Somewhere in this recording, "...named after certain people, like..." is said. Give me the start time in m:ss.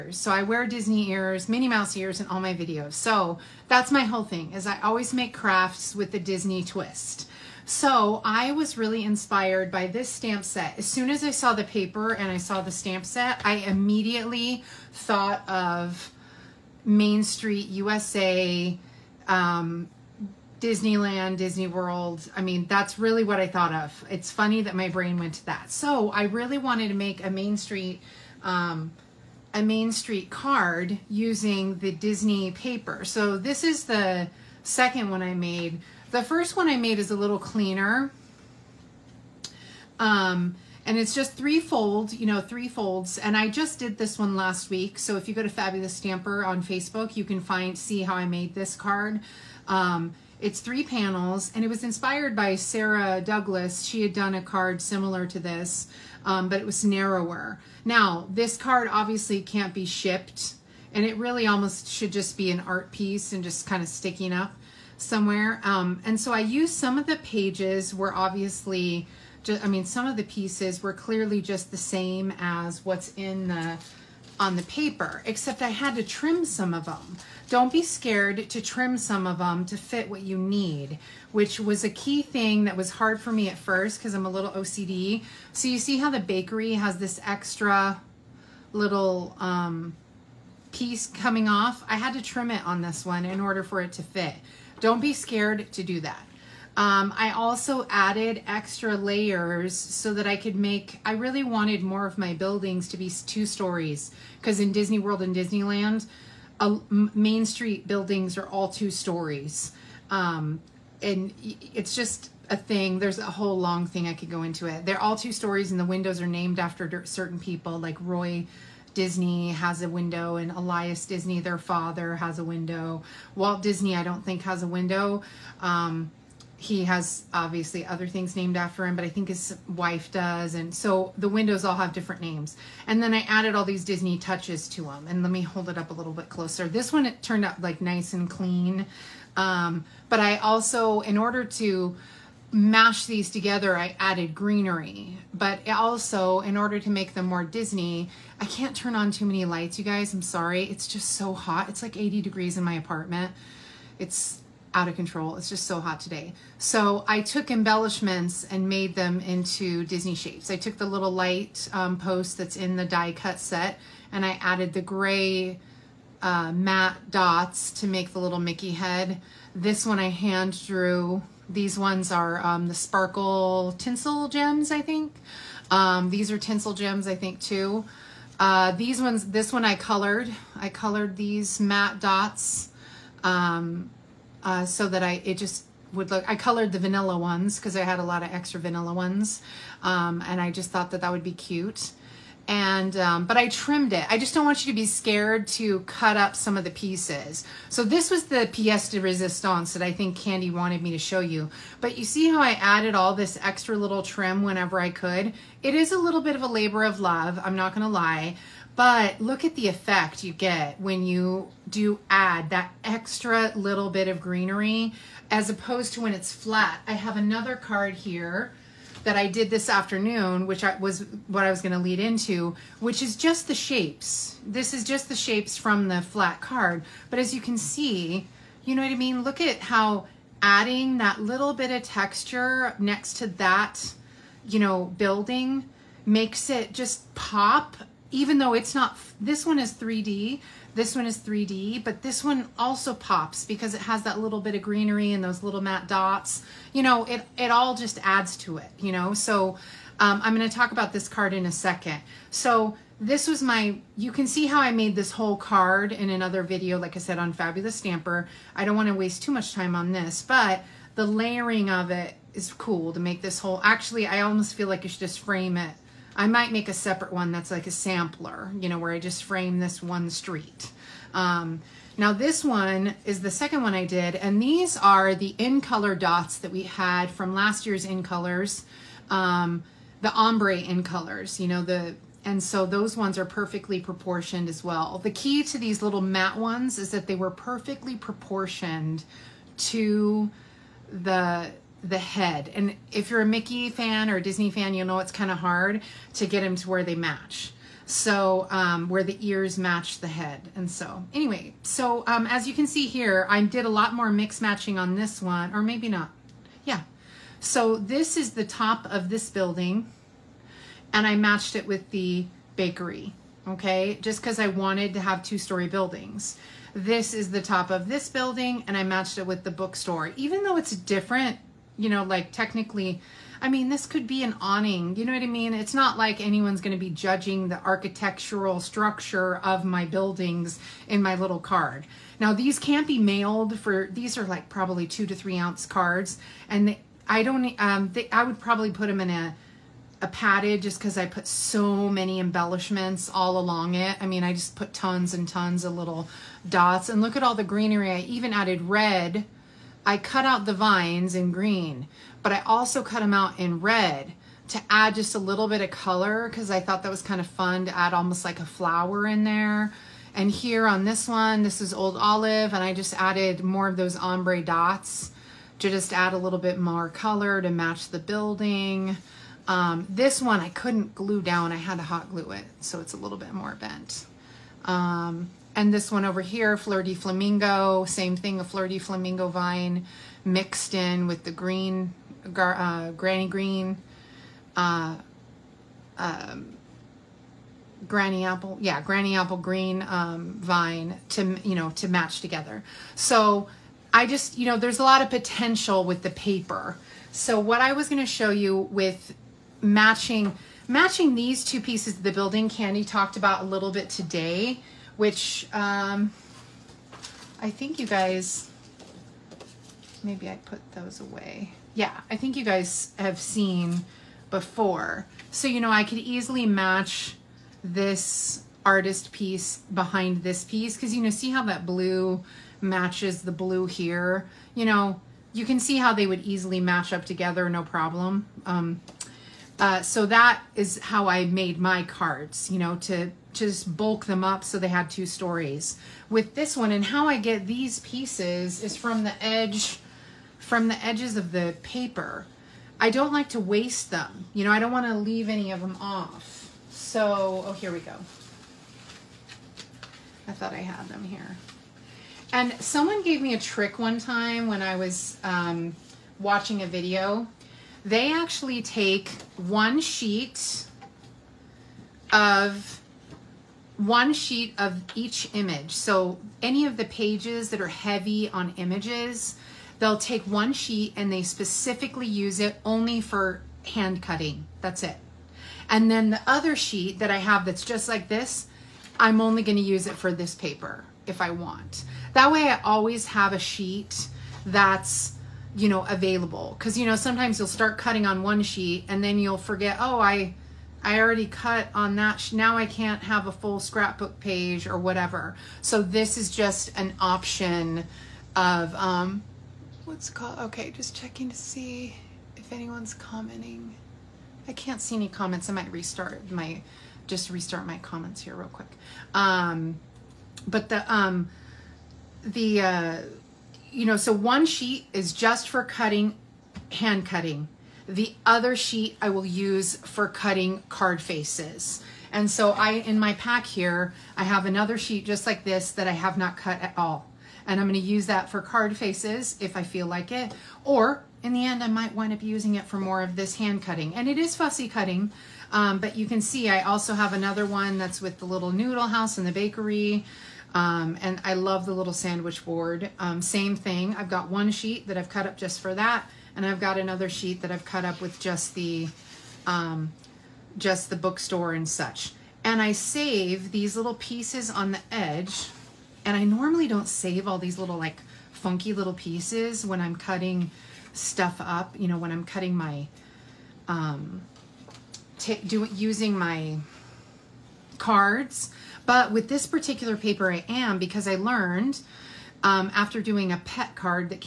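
1:56.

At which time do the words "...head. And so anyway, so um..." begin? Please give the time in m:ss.
5:00.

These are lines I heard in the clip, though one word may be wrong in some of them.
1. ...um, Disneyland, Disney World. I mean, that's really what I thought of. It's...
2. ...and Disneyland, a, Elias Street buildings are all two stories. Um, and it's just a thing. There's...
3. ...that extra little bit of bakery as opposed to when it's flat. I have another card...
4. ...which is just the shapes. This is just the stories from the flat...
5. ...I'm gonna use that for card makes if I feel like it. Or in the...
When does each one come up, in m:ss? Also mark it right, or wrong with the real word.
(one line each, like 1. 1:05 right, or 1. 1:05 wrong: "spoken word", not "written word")
1. 0:19 right
2. 1:45 wrong: "Main", not "Elias"
3. 3:32 wrong: "greenery", not "bakery"
4. 3:42 wrong: "shapes", not "stories"
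5. 8:47 wrong: "faces", not "makes".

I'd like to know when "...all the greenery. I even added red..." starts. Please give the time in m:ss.
5:47.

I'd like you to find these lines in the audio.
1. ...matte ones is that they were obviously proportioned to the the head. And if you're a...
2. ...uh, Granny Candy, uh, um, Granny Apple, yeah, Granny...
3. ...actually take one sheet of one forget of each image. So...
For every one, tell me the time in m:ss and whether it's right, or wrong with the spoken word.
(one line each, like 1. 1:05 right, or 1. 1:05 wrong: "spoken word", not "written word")
1. 4:46 wrong: "perfectly", not "obviously"
2. 6:22 wrong: "Green", not "Candy"
3. 7:38 wrong: "sheet", not "forget".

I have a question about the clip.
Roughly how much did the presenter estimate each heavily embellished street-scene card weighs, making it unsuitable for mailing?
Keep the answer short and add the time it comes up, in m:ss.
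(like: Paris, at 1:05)
2 to 3 ounces, at 5:34.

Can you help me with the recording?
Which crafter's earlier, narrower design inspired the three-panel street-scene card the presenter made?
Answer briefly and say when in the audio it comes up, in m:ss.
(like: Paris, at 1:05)
Sarah Douglas, at 0:52.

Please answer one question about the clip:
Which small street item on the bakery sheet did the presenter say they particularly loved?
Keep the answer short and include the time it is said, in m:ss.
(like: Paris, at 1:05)
sandwich board, at 9:01.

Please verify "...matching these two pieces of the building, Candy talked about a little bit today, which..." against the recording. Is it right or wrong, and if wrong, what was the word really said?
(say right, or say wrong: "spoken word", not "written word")
right.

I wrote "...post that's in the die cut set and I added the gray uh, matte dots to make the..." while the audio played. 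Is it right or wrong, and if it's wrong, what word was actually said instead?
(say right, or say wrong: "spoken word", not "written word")
right.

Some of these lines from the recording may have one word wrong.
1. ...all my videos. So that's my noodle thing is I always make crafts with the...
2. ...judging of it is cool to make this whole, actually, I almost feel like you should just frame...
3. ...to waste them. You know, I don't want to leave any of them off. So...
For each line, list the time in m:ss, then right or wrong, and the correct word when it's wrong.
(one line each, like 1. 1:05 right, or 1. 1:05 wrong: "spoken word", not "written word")
1. 0:02 wrong: "whole", not "noodle"
2. 4:21 wrong: "layering", not "judging"
3. 7:23 right.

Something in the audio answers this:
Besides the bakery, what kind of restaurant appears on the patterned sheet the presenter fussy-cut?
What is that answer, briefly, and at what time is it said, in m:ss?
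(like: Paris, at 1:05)
noodle house, at 8:58.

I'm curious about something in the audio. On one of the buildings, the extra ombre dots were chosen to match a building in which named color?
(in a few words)
Old Olive.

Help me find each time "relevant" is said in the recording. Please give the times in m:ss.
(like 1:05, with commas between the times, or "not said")
not said.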